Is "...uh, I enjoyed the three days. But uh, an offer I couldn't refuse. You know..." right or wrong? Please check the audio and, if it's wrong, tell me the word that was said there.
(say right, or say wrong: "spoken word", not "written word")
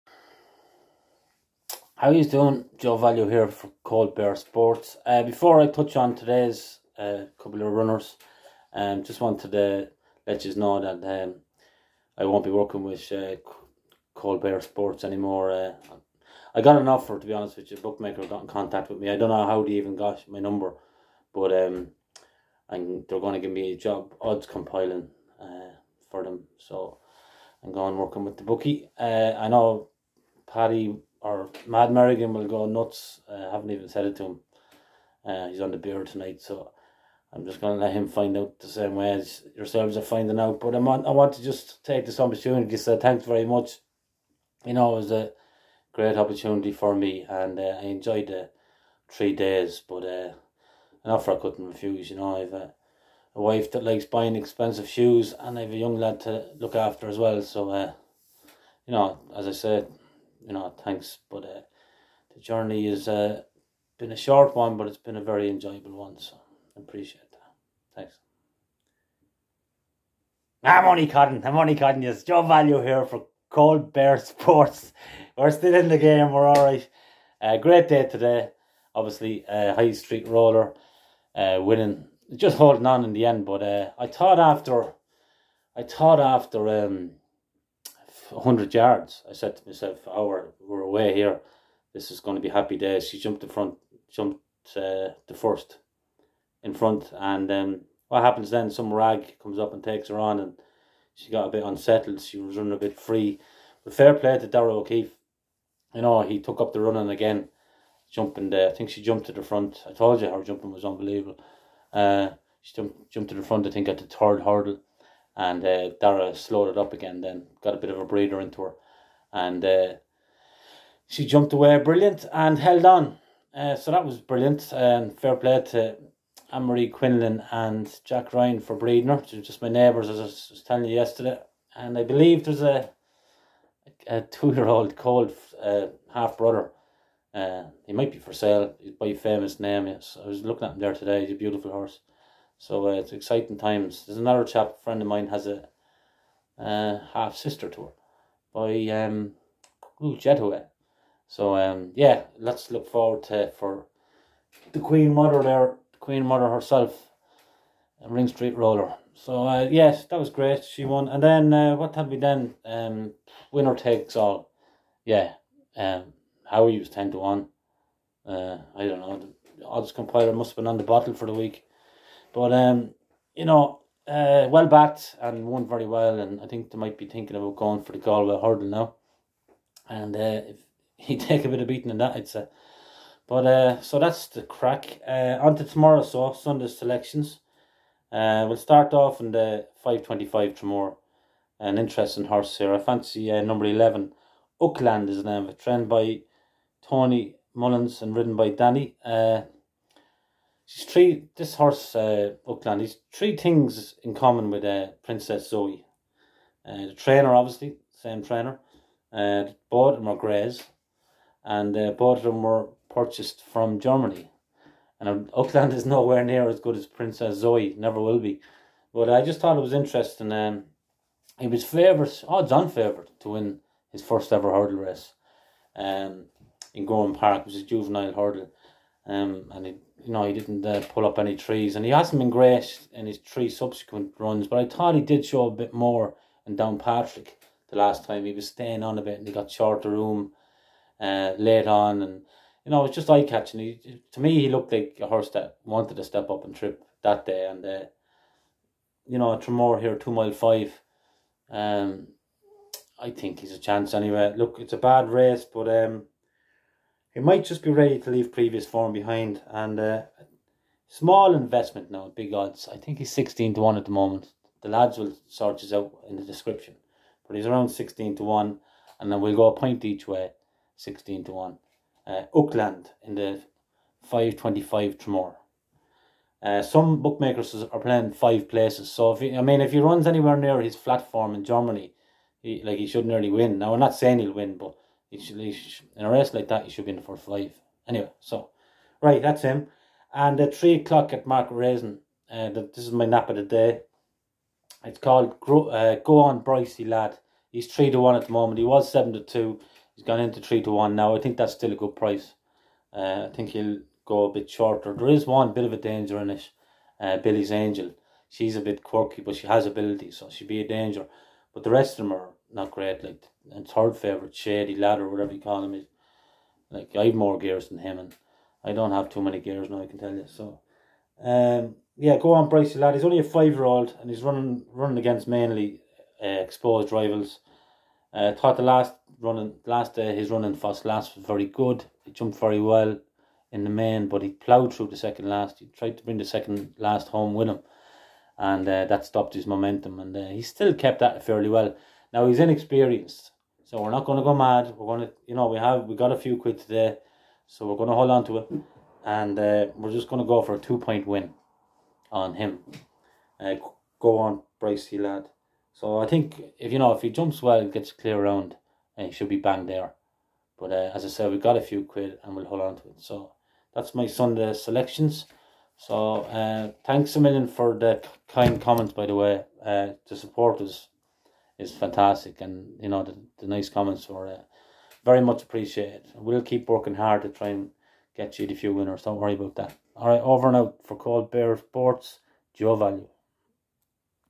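right.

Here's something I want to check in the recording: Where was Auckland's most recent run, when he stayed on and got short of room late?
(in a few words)
Downpatrick.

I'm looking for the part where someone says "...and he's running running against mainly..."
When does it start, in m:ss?
5:23.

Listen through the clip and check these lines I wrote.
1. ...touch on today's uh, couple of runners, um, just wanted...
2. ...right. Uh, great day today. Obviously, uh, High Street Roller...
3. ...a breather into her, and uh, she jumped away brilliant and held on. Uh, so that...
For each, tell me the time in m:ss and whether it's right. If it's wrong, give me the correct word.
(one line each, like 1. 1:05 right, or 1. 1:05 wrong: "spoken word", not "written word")
1. 0:05 right
2. 1:16 right
3. 1:57 right.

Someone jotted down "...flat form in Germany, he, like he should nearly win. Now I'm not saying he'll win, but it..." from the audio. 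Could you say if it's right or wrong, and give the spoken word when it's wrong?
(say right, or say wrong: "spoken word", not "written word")
right.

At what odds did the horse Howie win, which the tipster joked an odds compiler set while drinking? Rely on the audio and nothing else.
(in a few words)
10 to 1.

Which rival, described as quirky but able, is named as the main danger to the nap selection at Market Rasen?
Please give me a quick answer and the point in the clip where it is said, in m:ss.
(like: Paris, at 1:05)
Billy's Angel, at 5:07.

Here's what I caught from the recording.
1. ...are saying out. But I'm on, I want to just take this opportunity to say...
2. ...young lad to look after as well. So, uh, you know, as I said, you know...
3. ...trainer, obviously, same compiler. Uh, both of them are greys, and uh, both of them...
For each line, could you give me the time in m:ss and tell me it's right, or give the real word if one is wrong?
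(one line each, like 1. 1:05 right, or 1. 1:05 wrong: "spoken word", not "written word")
1. 0:39 wrong: "finding", not "saying"
2. 0:55 right
3. 3:26 wrong: "trainer", not "compiler".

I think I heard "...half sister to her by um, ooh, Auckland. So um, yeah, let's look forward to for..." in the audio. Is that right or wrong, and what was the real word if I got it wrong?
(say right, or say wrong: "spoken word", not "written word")
wrong: "Jetuet", not "Auckland".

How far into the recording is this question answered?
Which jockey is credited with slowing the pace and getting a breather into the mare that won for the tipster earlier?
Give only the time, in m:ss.
1:44.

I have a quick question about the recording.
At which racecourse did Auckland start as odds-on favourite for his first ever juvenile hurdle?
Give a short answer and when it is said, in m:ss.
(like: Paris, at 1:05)
Gowran Park, at 3:46.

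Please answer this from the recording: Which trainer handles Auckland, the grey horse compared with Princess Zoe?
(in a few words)
Tony Mullins.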